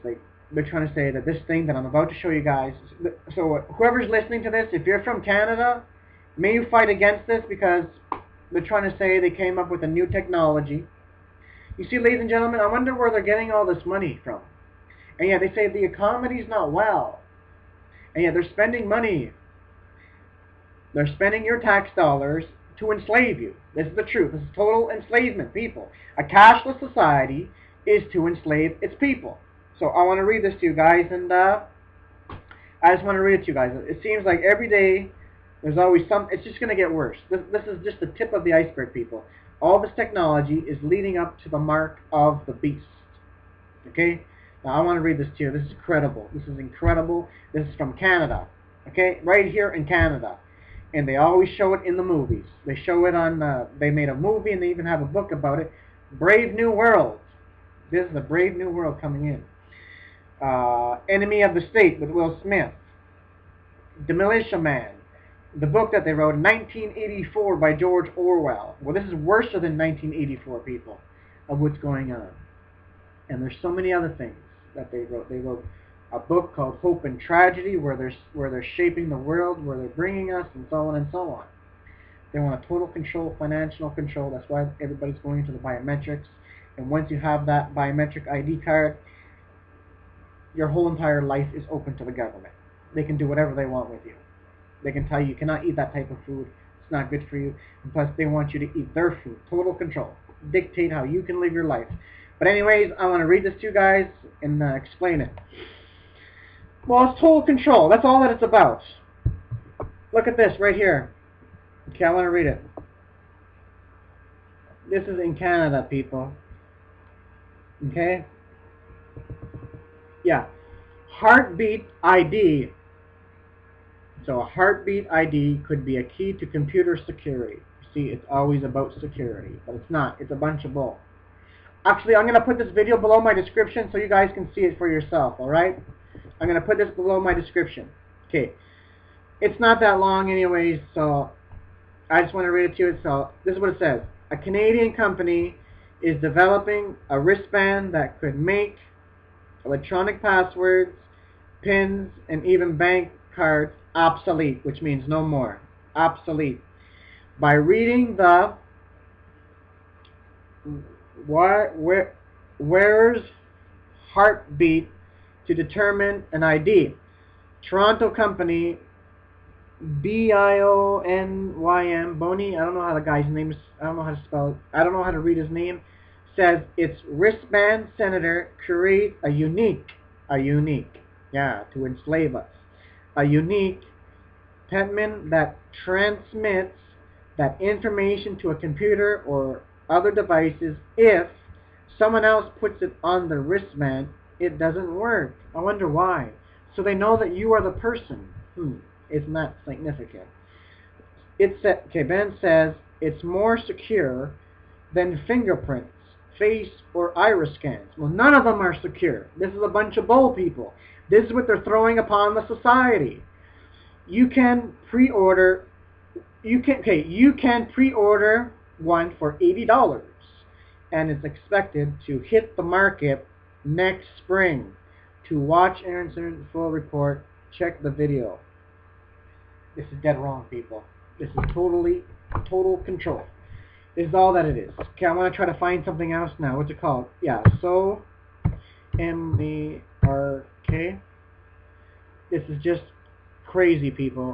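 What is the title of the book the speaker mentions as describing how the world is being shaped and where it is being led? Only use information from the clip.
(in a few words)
Hope and Tragedy.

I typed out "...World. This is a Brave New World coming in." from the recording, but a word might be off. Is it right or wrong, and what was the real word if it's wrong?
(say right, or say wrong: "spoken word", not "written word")
right.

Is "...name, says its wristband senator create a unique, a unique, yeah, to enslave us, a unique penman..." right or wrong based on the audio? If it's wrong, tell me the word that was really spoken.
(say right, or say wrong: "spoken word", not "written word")
right.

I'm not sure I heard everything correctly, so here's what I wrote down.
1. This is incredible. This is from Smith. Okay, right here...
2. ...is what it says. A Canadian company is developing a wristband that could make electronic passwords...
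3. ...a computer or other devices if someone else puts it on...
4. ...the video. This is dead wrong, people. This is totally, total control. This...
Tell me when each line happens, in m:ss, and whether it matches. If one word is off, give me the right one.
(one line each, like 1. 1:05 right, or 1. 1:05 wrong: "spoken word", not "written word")
1. 0:46 wrong: "Canada", not "Smith"
2. 2:23 right
3. 3:08 right
4. 3:47 right.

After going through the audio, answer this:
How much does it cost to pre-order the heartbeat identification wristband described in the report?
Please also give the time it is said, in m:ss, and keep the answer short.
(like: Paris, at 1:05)
$80, at 3:39.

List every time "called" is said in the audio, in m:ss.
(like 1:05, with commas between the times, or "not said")
1:16, 3:56.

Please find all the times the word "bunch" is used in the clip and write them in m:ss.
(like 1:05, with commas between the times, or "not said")
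2:10, 3:29.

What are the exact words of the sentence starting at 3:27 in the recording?
Well, none of them are secure.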